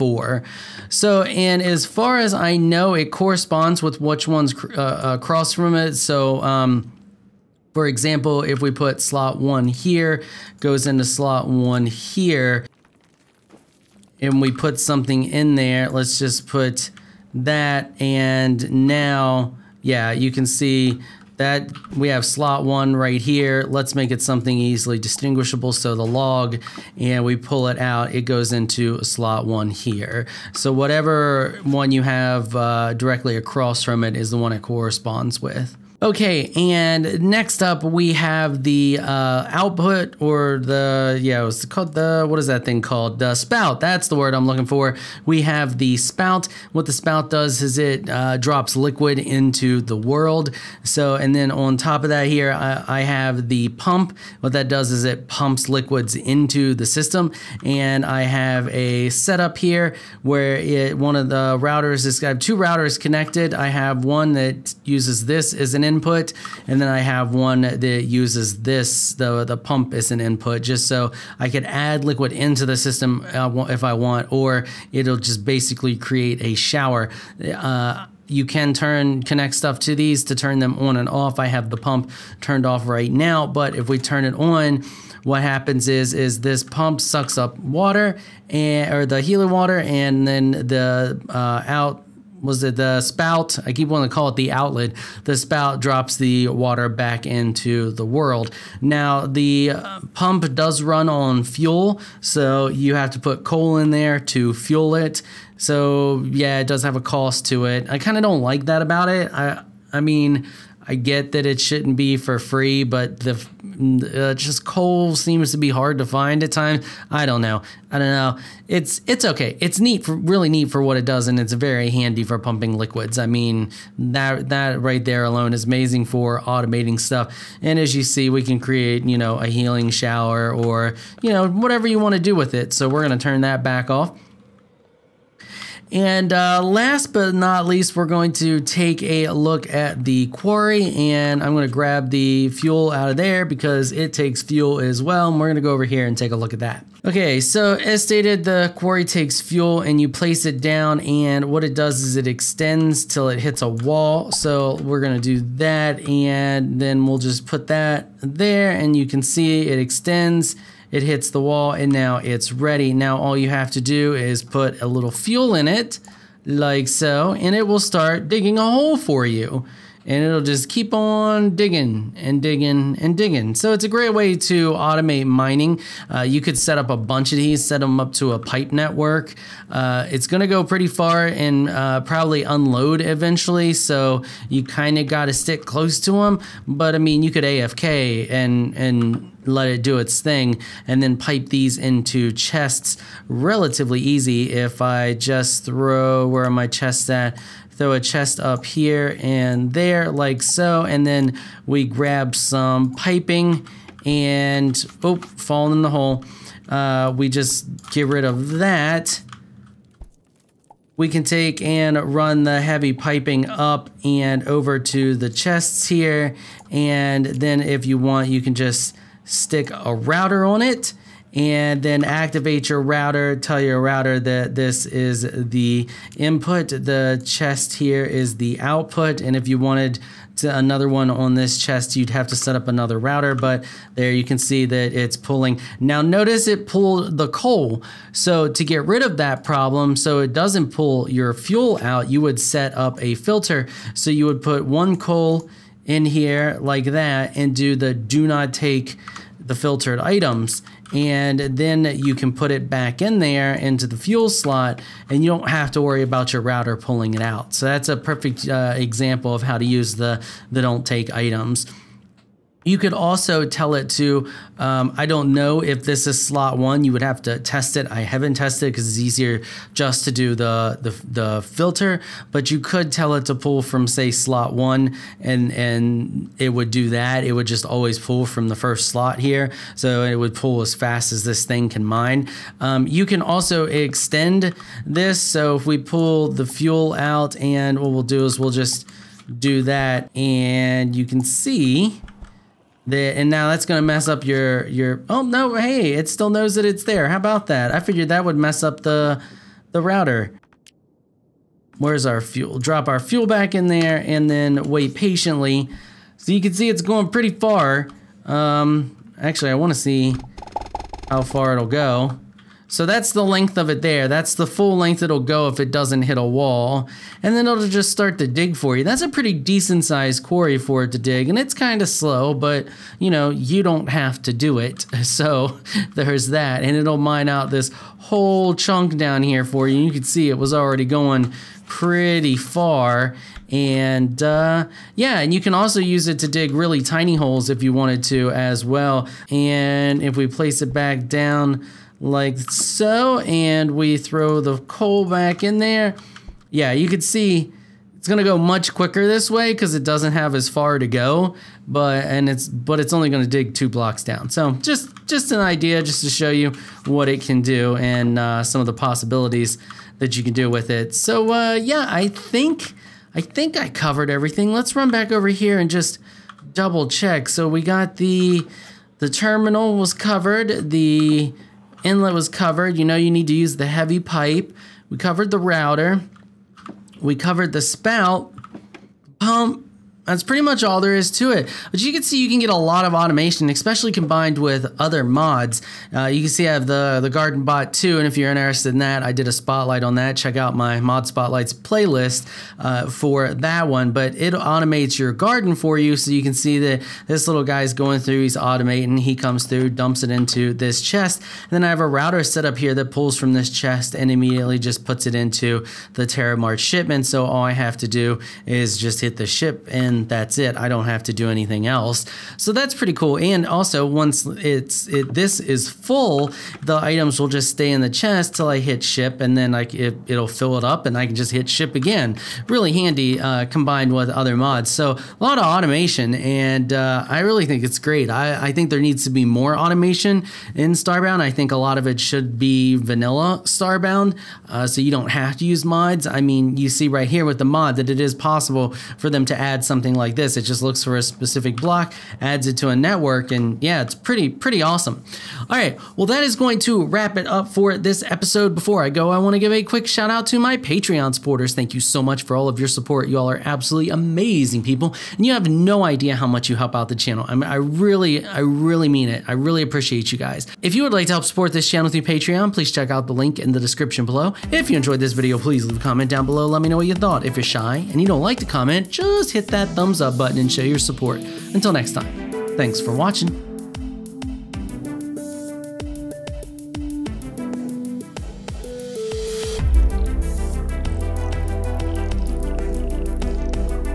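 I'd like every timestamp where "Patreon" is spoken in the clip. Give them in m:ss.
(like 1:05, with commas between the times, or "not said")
7:30, 7:42.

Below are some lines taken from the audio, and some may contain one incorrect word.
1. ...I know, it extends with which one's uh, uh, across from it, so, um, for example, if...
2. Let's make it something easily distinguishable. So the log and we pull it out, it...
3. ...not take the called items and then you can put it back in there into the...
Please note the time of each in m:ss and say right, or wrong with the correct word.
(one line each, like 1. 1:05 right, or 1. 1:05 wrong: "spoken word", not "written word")
1. 0:02 wrong: "corresponds", not "extends"
2. 0:23 right
3. 4:08 wrong: "filtered", not "called".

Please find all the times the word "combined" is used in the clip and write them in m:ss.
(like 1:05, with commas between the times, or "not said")
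6:23, 7:03.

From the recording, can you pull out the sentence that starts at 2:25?
And we're gonna go over here and take a look at that.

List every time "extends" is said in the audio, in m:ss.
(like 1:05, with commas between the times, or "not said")
2:32, 2:39, 4:43.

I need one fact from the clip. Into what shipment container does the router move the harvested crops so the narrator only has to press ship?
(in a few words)
TerraMart shipment.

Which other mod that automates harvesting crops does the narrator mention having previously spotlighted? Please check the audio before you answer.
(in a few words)
Garden Bot.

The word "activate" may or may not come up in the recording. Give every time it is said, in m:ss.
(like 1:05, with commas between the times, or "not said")
3:42.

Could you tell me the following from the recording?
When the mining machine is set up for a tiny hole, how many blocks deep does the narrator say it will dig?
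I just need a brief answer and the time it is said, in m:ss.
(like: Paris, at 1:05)
2, at 5:53.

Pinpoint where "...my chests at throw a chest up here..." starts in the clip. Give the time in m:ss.
3:16.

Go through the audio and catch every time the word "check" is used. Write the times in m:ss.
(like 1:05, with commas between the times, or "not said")
6:06, 6:30, 7:42.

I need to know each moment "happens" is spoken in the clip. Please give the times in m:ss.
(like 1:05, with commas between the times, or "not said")
1:25.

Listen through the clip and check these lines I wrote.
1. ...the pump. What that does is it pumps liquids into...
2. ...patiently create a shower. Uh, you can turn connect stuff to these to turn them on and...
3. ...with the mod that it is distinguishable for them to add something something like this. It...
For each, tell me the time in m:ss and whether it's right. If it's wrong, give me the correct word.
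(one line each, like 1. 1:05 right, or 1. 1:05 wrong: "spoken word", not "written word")
1. 0:53 right
2. 1:15 wrong: "basically", not "patiently"
3. 7:17 wrong: "possible", not "distinguishable".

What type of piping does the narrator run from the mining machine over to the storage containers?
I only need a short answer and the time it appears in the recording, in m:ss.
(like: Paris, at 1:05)
heavy piping, at 3:32.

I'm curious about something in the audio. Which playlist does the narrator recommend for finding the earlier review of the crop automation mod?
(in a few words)
Mod Spotlights.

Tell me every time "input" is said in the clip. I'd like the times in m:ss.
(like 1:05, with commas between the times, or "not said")
1:05, 1:10, 3:46.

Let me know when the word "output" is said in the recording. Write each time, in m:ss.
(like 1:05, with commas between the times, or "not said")
0:39, 3:48.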